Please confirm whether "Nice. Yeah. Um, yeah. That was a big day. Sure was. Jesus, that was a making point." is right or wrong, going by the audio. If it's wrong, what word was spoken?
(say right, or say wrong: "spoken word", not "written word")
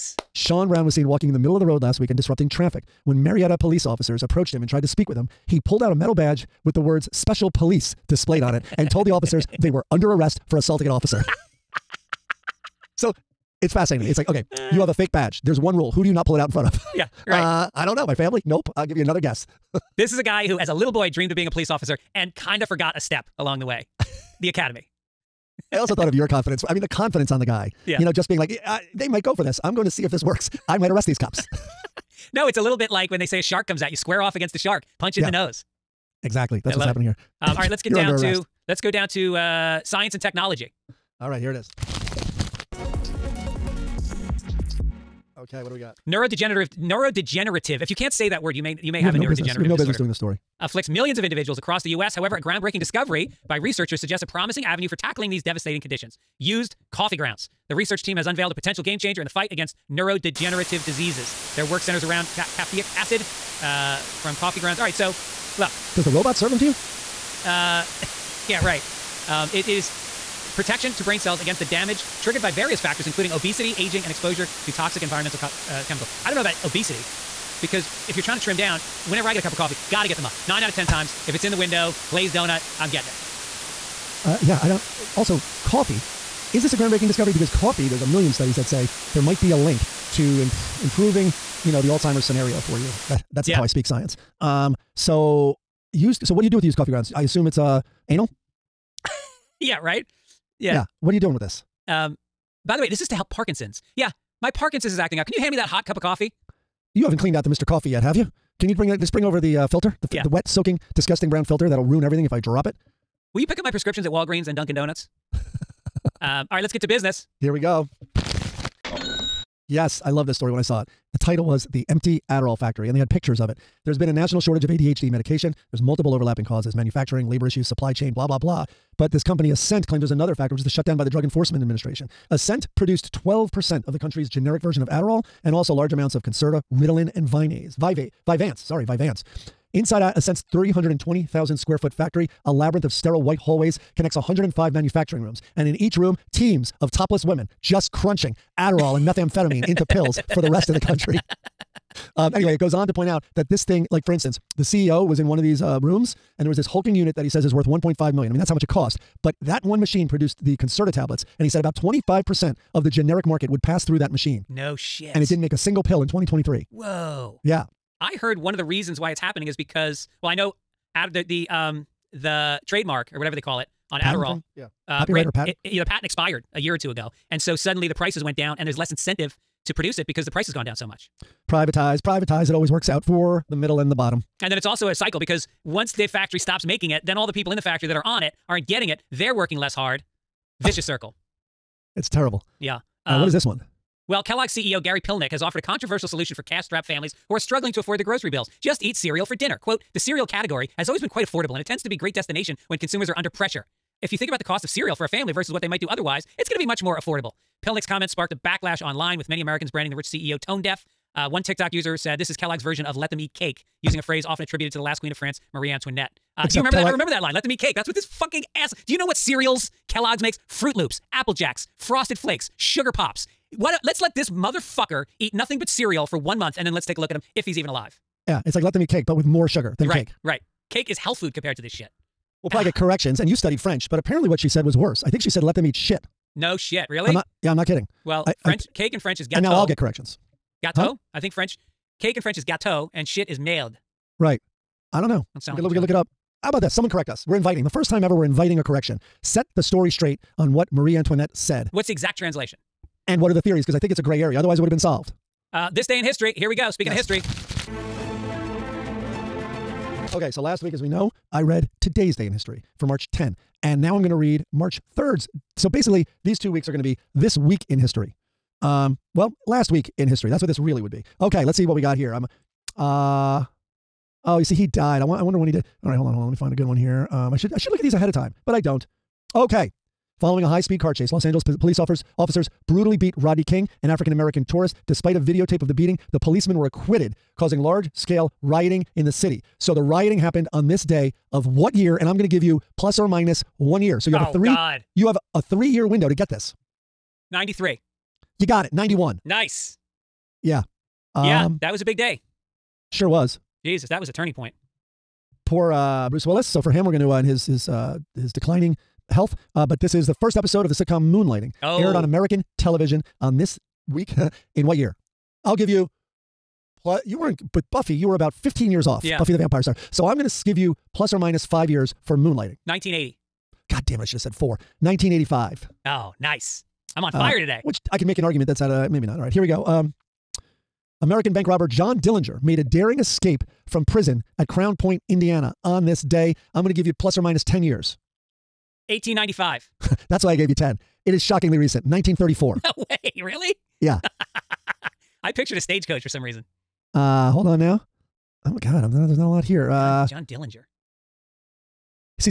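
wrong: "turning", not "making".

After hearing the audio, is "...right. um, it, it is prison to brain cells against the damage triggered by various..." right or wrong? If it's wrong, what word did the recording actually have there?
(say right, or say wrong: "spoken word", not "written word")
wrong: "protection", not "prison".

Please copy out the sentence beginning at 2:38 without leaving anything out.
I mean, that's how much it cost.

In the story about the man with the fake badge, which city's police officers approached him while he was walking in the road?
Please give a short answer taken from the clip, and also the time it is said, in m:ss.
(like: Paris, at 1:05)
Marietta, at 0:03.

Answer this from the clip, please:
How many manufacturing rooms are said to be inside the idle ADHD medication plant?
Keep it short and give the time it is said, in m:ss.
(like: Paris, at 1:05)
105, at 2:24.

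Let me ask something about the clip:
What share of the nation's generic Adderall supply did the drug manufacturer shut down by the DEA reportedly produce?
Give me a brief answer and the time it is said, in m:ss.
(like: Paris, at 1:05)
12%, at 2:13.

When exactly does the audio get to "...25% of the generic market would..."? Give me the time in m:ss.
2:41.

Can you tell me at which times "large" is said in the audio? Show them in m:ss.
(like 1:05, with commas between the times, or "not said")
2:15, 4:47.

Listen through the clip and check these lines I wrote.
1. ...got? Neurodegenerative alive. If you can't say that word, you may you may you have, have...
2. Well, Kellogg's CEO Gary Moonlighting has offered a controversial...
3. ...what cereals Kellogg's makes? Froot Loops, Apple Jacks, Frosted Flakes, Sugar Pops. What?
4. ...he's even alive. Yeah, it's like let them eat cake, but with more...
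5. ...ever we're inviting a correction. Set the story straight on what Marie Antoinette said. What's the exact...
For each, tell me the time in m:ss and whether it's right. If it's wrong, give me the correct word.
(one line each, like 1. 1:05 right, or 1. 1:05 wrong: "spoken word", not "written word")
1. 0:45 wrong: "neurodegenerative", not "alive"
2. 3:14 wrong: "Pilnick", not "Moonlighting"
3. 3:39 right
4. 3:47 right
5. 4:08 right.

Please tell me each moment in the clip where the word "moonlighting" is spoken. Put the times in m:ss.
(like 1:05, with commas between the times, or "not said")
5:11, 5:22.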